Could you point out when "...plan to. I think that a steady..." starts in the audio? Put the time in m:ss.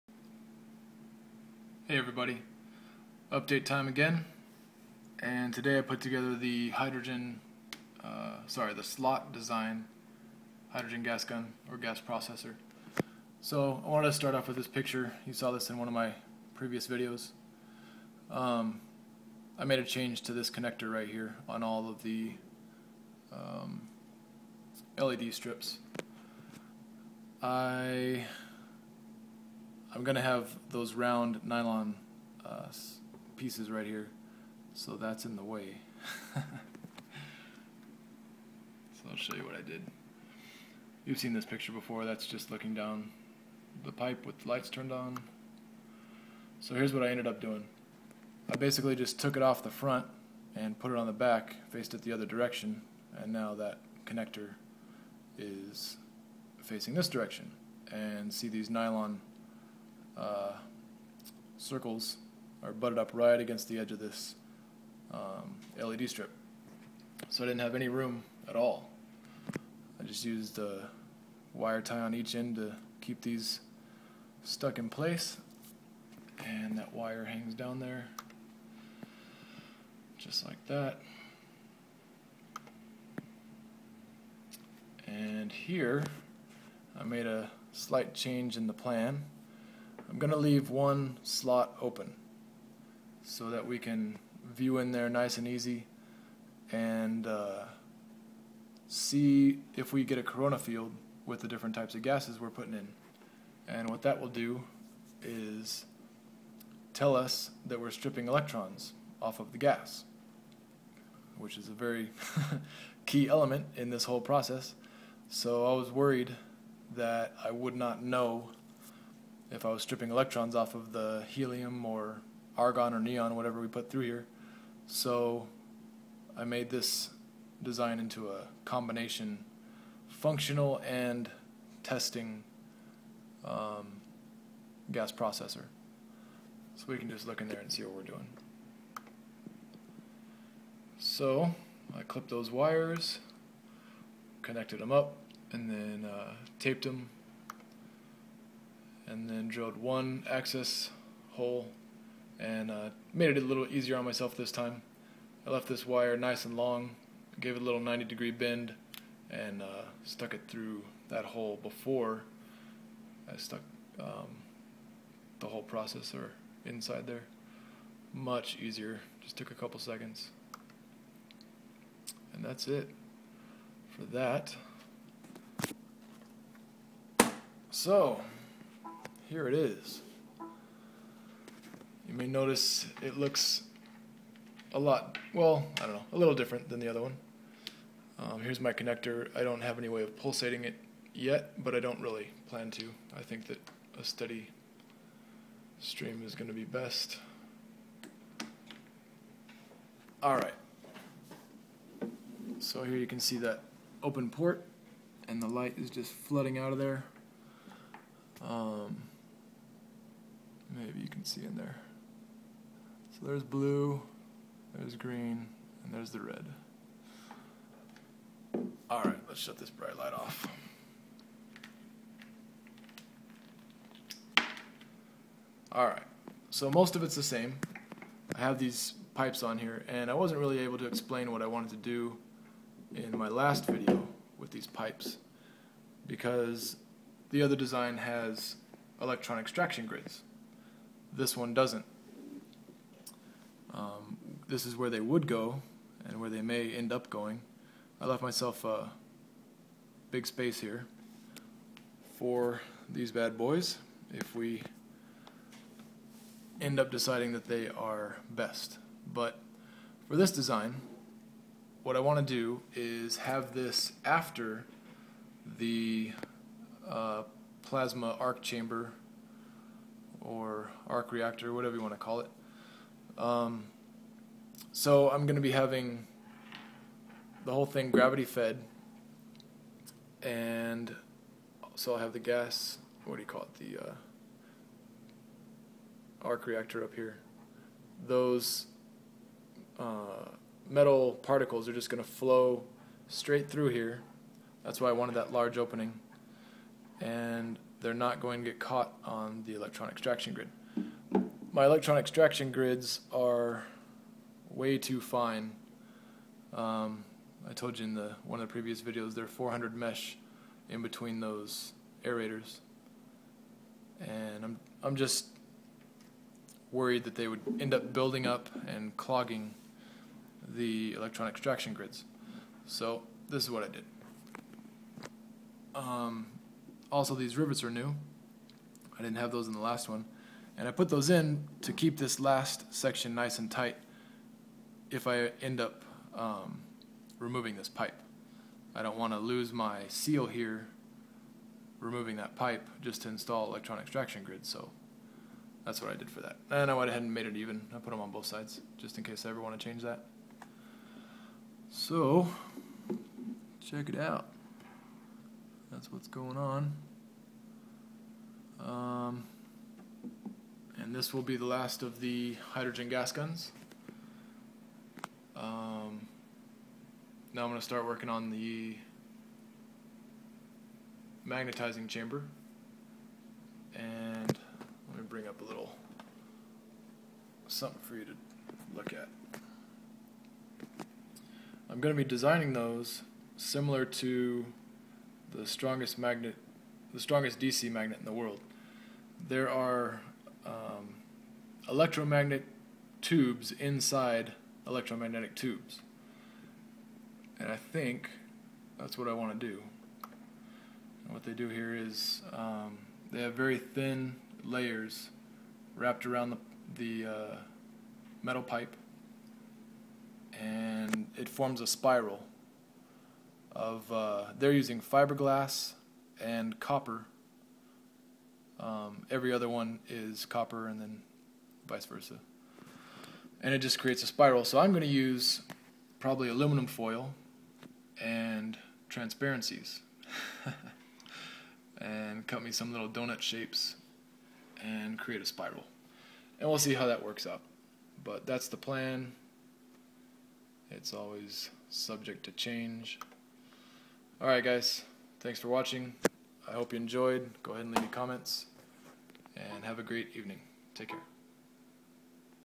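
3:12.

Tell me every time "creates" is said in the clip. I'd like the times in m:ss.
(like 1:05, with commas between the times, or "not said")
7:03, 7:14.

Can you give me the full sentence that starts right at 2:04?
So I made this design into a combination functional and testing um, gas processor.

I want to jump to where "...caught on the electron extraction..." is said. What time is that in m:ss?
4:58.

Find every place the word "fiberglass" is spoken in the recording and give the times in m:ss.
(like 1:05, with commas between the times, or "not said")
6:54.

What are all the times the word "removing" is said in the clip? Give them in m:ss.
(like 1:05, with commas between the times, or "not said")
5:37, 5:41.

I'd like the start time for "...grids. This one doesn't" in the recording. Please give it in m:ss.
3:59.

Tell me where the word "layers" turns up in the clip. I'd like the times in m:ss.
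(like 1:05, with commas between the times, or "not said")
6:44.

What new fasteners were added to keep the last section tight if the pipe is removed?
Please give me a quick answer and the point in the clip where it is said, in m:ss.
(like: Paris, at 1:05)
rivets, at 5:27.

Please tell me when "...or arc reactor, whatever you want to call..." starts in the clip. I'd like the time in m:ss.
4:30.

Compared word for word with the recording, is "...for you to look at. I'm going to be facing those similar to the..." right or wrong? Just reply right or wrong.
wrong.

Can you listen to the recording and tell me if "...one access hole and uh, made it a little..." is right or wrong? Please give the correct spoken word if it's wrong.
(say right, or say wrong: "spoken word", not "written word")
right.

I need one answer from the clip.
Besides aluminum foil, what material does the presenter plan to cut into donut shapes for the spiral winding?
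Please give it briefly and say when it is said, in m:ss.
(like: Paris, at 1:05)
transparencies, at 7:08.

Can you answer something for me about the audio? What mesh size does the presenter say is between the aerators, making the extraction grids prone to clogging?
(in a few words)
400 mesh.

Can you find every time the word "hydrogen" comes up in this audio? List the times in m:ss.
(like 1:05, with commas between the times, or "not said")
0:06, 0:10, 6:02.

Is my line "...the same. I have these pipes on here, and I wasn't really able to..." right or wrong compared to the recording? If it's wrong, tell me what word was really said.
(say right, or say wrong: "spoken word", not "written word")
right.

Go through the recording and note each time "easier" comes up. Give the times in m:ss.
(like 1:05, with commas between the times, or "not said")
2:33, 2:48.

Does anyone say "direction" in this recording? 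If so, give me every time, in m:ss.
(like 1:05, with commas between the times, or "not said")
0:52, 0:57.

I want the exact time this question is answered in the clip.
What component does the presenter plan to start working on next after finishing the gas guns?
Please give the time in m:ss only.
6:11.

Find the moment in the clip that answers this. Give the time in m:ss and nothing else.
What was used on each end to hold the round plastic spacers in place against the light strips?
1:11.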